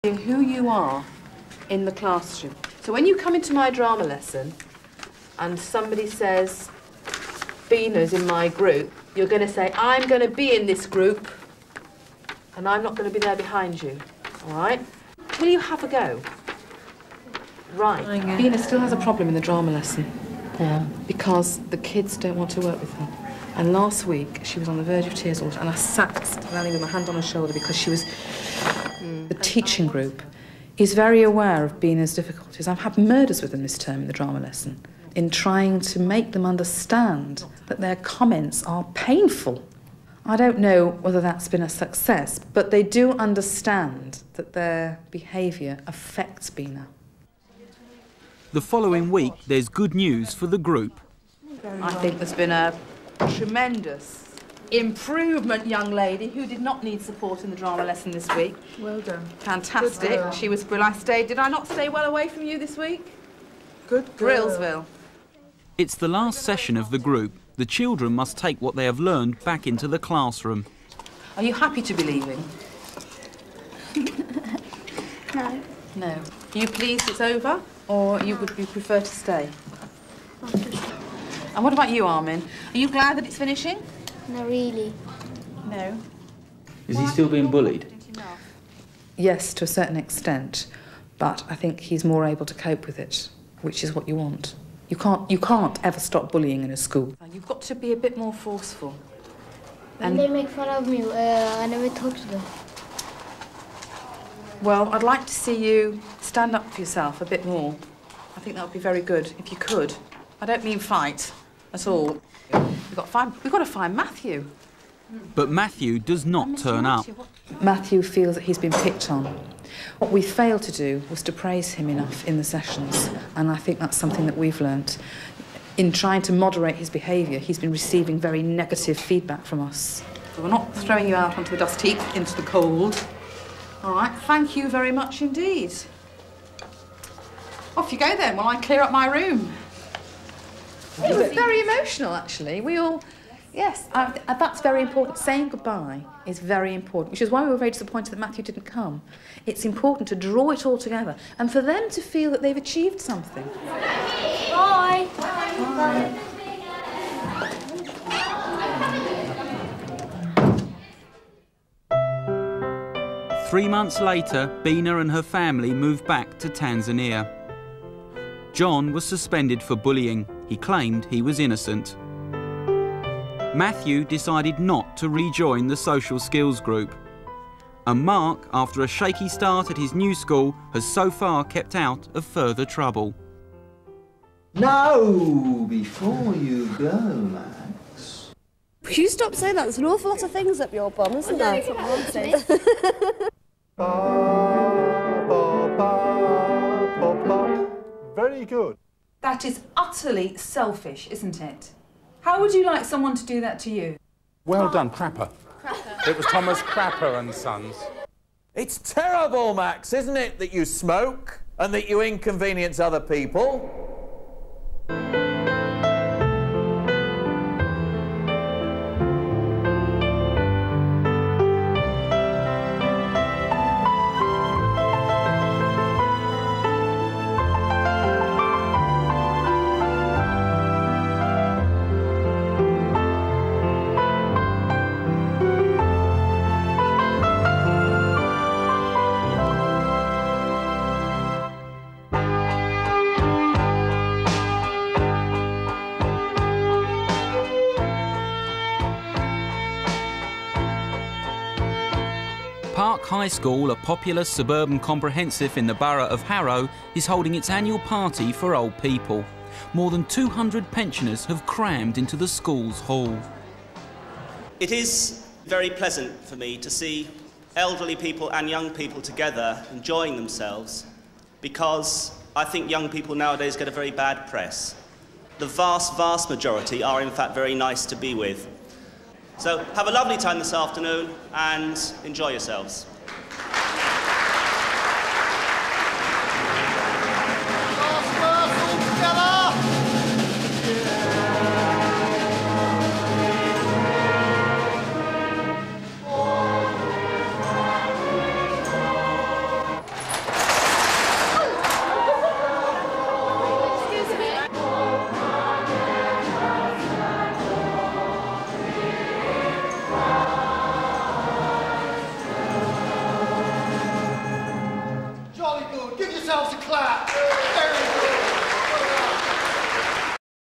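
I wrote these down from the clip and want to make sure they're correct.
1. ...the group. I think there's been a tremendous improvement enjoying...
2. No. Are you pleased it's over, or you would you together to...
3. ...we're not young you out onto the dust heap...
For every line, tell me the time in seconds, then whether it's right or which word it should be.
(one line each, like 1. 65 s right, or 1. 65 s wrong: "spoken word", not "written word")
1. 50 s wrong: "young", not "enjoying"
2. 75 s wrong: "prefer", not "together"
3. 130 s wrong: "throwing", not "young".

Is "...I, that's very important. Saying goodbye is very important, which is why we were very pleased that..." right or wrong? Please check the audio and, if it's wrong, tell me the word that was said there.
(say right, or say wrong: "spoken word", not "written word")
wrong: "disappointed", not "pleased".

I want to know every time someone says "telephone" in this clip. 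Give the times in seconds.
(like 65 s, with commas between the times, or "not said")
not said.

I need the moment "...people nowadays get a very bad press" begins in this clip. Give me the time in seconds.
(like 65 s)
272 s.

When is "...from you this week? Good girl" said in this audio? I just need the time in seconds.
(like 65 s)
62 s.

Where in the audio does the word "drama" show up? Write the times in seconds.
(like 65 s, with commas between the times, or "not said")
3 s, 19 s, 34 s, 57 s.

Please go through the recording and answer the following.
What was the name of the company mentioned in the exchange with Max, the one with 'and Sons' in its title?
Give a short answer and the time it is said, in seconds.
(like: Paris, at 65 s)
Thomas Crapper and Sons, at 206 s.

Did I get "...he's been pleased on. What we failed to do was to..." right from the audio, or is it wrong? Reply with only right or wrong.
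wrong.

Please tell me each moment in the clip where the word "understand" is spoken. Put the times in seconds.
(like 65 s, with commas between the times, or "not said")
36 s, 43 s.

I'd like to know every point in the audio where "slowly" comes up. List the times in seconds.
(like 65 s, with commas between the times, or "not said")
not said.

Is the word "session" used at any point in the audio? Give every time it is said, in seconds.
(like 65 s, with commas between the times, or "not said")
66 s, 122 s.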